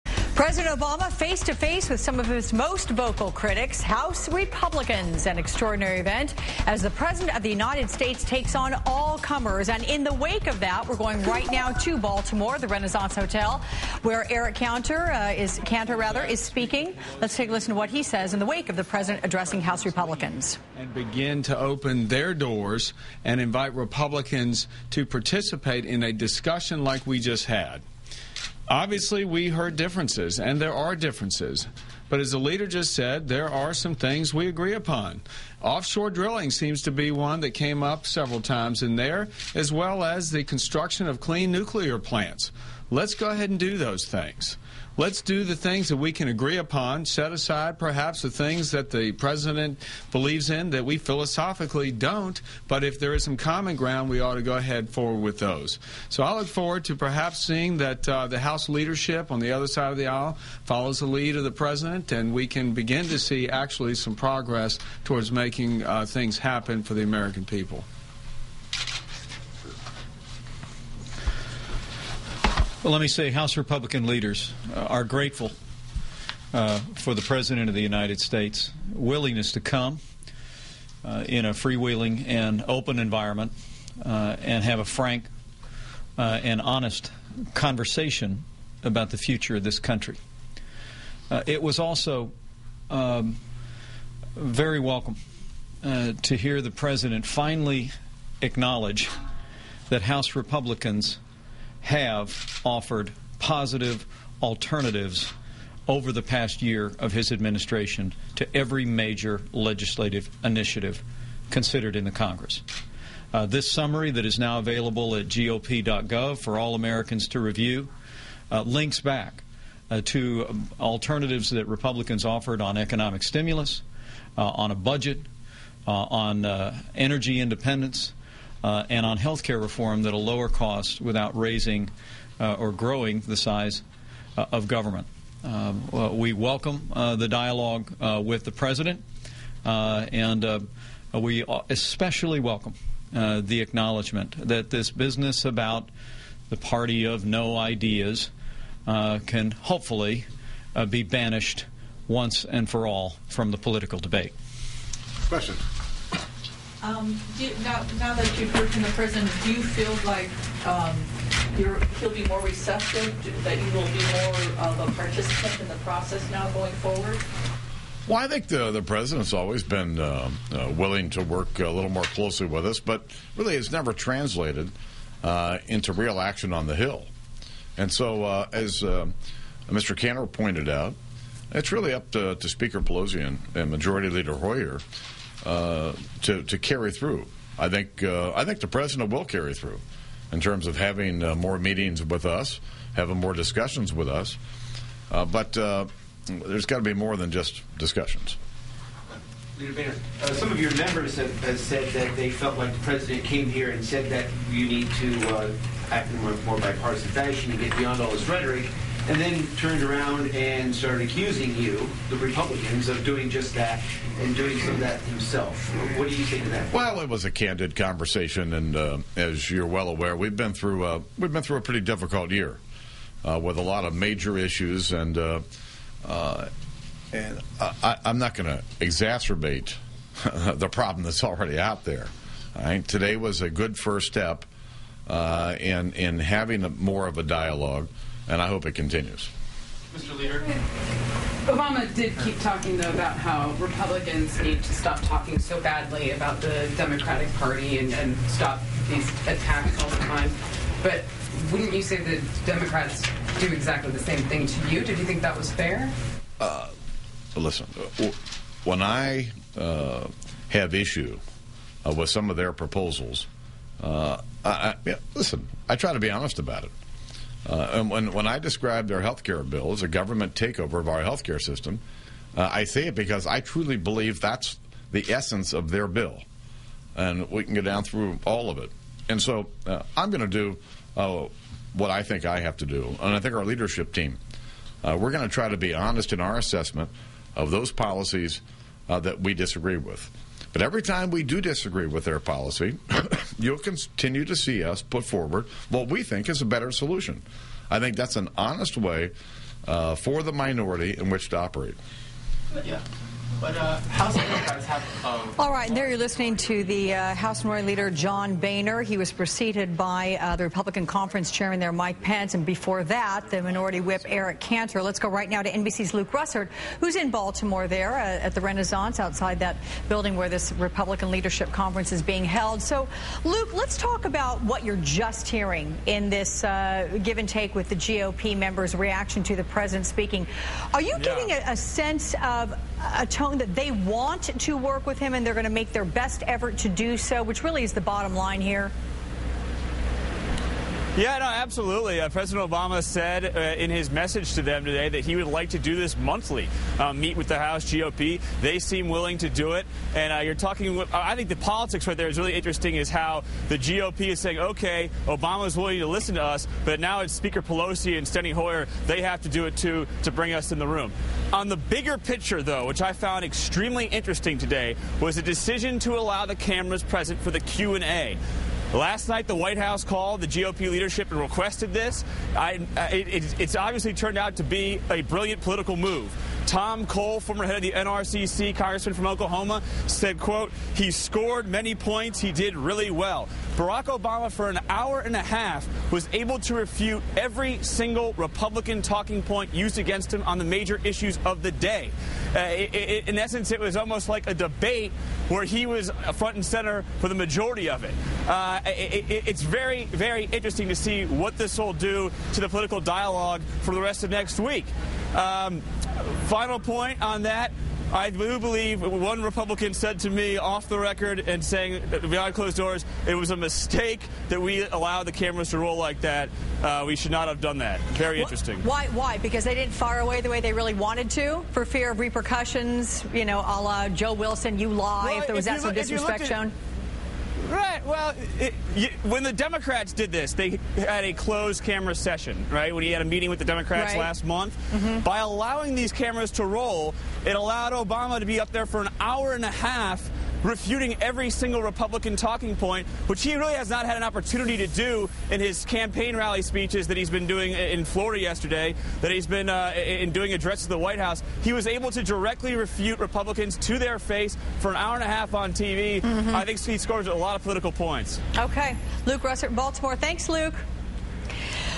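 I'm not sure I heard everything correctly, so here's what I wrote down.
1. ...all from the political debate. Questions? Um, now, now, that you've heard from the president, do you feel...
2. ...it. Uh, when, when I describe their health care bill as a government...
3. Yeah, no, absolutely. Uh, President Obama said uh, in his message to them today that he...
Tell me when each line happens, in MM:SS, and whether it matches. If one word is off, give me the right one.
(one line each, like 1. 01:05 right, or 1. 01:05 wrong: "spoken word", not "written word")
1. 02:32 right
2. 04:26 right
3. 05:40 right.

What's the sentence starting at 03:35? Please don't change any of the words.
What do you think of that?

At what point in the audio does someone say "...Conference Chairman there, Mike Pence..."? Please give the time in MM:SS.
05:10.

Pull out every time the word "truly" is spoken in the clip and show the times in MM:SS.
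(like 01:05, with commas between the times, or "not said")
04:33.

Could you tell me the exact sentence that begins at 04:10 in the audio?
But wouldn't you say the Democrats do exactly the same thing to you?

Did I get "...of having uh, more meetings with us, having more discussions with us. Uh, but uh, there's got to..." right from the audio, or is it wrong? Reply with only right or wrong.
right.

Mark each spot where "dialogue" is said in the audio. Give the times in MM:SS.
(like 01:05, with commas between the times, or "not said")
02:17, 03:57, 06:42.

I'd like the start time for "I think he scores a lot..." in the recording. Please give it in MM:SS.
07:36.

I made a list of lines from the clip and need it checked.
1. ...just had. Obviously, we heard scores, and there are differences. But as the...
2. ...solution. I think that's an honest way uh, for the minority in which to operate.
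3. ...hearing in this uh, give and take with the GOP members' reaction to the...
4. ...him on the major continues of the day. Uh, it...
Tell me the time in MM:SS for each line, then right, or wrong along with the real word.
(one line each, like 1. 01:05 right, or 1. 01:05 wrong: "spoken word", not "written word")
1. 00:27 wrong: "differences", not "scores"
2. 04:56 right
3. 05:25 right
4. 06:30 wrong: "issues", not "continues".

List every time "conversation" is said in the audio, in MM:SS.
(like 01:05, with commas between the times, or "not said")
01:27, 03:37.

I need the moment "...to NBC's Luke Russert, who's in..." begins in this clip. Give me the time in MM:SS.
05:15.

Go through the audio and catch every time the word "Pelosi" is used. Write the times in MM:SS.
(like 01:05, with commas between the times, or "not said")
03:02, 05:57.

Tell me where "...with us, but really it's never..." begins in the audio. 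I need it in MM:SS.
02:52.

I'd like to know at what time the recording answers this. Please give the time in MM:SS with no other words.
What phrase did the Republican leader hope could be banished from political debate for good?
02:26.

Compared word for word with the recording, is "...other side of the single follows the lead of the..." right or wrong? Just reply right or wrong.
wrong.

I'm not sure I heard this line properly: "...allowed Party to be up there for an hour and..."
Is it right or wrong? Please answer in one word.
wrong.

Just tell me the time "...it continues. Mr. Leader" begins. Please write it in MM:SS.
03:58.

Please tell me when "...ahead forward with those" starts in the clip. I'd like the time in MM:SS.
00:54.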